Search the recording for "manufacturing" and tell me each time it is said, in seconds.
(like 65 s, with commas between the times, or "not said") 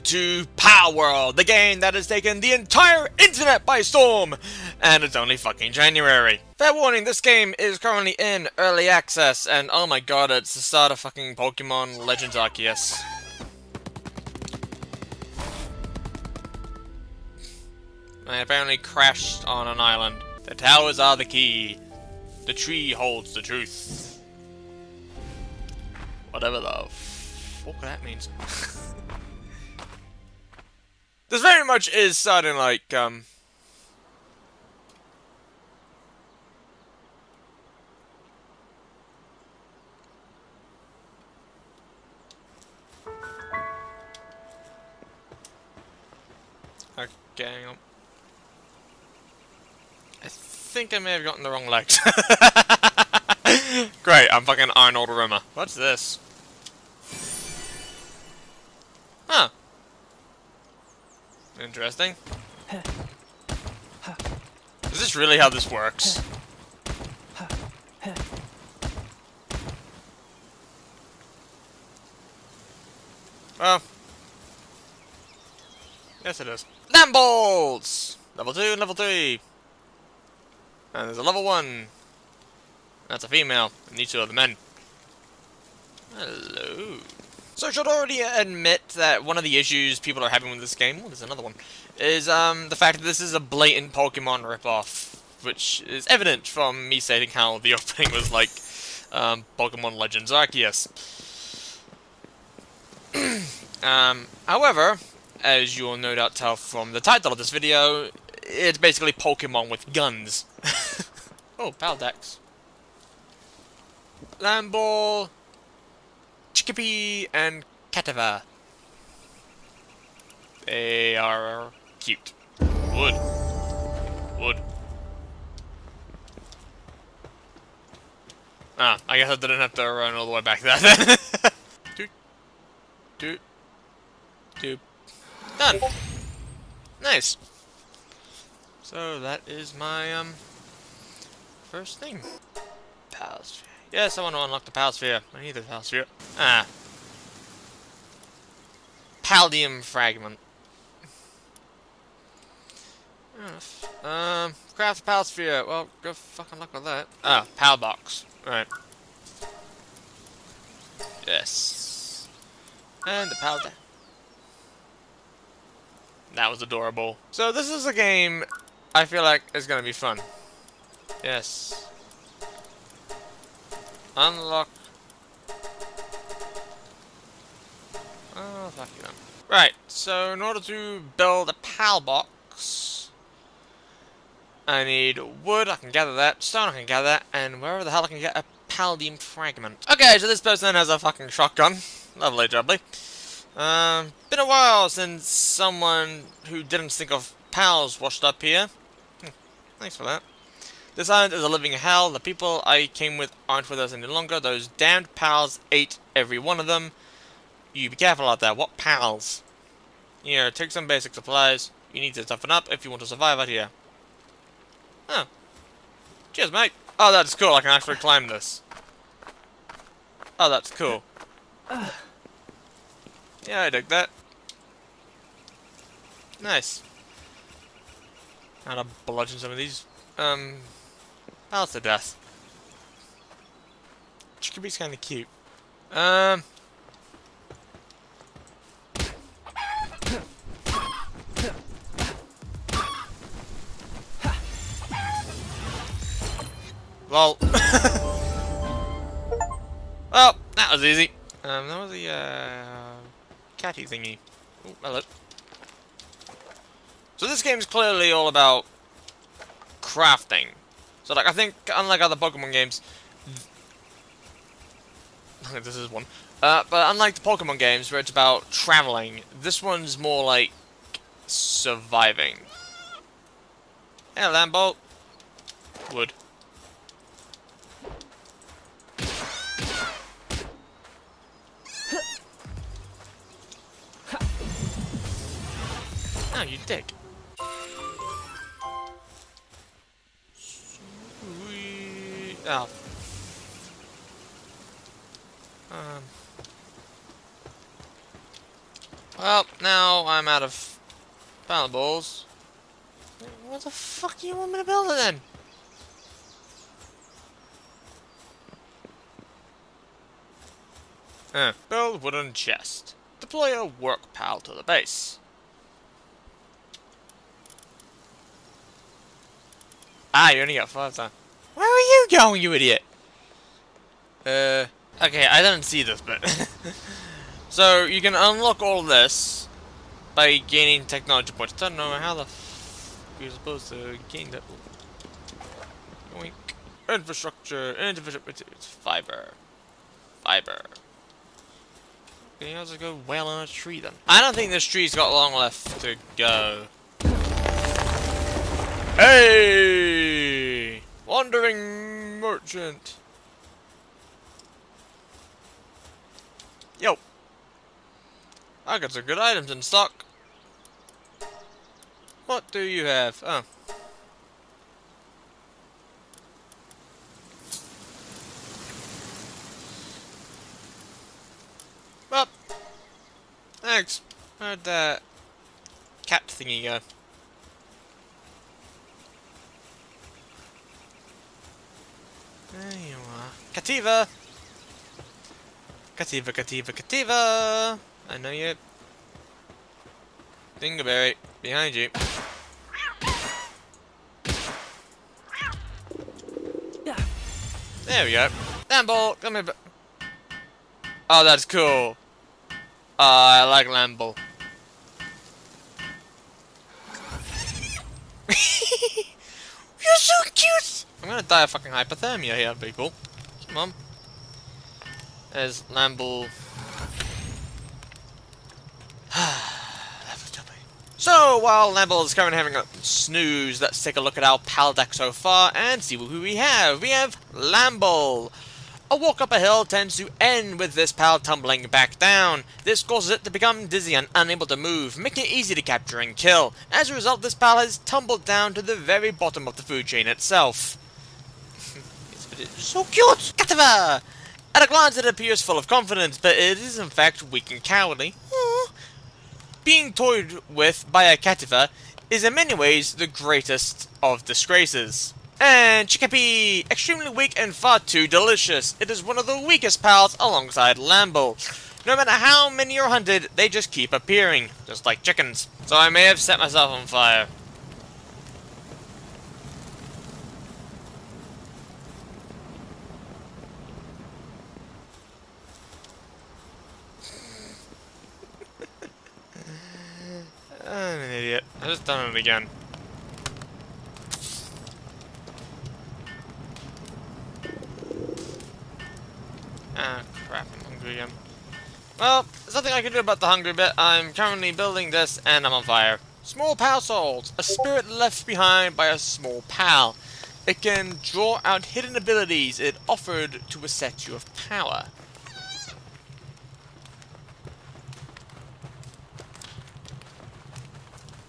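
not said.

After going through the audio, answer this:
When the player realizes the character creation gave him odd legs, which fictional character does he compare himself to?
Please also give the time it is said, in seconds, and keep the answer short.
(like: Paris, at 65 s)
Arnold Rimmer, at 54 s.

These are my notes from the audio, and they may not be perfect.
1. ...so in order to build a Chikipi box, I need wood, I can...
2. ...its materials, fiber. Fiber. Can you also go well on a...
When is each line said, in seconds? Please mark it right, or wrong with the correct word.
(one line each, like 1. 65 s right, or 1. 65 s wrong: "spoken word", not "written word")
1. 179 s wrong: "PAL", not "Chikipi"
2. 337 s right.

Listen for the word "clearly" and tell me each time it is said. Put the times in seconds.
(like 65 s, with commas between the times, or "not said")
257 s.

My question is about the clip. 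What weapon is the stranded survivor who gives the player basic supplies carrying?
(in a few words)
shotgun.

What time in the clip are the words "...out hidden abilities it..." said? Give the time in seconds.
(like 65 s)
501 s.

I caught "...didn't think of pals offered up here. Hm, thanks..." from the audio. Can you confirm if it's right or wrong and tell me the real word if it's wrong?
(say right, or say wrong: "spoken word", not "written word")
wrong: "washed", not "offered".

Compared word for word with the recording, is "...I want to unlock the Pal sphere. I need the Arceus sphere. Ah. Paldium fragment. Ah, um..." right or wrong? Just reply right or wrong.
wrong.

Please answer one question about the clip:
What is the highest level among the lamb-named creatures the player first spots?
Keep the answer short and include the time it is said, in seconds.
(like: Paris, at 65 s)
3, at 78 s.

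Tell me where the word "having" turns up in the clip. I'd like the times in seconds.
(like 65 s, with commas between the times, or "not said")
90 s, 422 s.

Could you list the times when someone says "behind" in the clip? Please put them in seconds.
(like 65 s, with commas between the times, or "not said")
391 s, 498 s.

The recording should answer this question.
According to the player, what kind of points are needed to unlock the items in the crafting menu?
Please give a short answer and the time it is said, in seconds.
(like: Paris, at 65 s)
technology points, at 330 s.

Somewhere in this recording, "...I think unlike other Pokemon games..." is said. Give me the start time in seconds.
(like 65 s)
261 s.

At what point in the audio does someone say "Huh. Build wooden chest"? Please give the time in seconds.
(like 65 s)
311 s.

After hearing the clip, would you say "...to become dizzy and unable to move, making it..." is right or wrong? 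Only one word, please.
right.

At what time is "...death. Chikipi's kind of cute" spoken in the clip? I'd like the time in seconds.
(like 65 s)
231 s.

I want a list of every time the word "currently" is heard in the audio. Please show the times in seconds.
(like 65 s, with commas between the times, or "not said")
7 s, 422 s, 494 s.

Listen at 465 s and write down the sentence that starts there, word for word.
So I may have set myself on fire.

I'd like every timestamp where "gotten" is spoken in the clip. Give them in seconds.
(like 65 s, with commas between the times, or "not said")
51 s.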